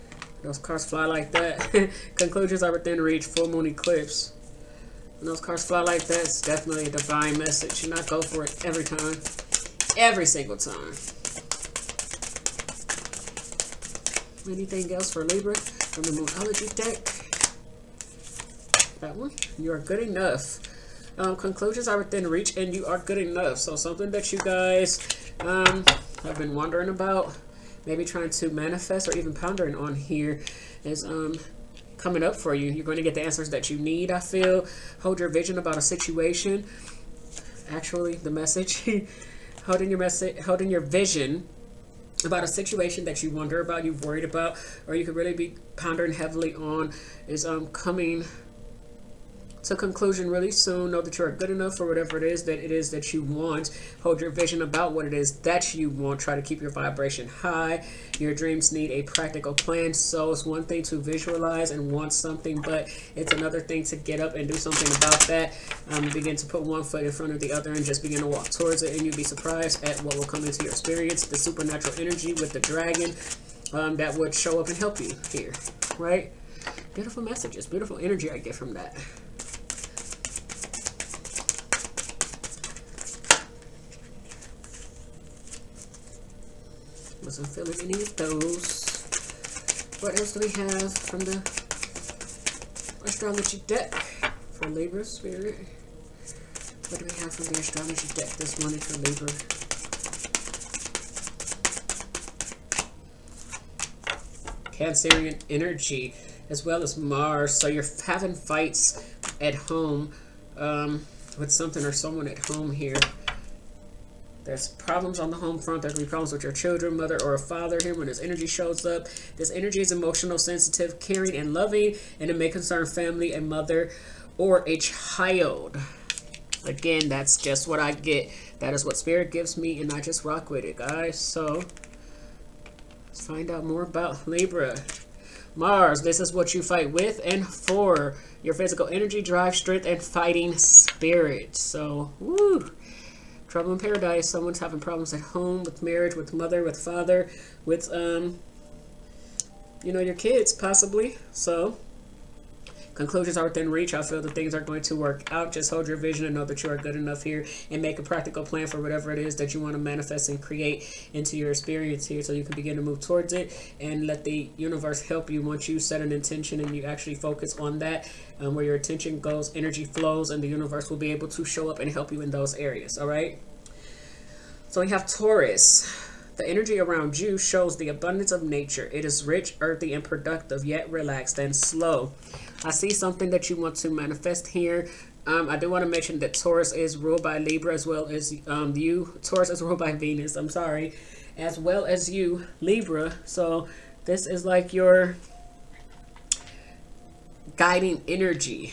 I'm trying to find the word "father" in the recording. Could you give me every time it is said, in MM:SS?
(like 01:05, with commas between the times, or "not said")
01:57, 02:26.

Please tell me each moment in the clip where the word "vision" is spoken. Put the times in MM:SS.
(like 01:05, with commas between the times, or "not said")
00:35, 00:40, 00:54, 02:35.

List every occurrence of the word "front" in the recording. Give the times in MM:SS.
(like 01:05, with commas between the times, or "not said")
01:07, 01:55.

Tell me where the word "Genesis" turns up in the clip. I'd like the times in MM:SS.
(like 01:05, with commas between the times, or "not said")
not said.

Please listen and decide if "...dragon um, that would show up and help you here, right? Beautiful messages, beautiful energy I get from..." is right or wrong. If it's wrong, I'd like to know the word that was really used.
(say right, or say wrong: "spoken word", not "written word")
right.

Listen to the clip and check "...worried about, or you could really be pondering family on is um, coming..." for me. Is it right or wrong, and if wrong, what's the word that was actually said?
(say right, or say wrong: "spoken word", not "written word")
wrong: "heavily", not "family".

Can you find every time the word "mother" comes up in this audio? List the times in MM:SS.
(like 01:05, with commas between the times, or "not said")
01:56, 02:03, 02:26.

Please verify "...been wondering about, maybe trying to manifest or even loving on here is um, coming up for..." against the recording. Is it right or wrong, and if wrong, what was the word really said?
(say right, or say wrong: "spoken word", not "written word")
wrong: "pondering", not "loving".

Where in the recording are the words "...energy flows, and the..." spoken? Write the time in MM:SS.
02:49.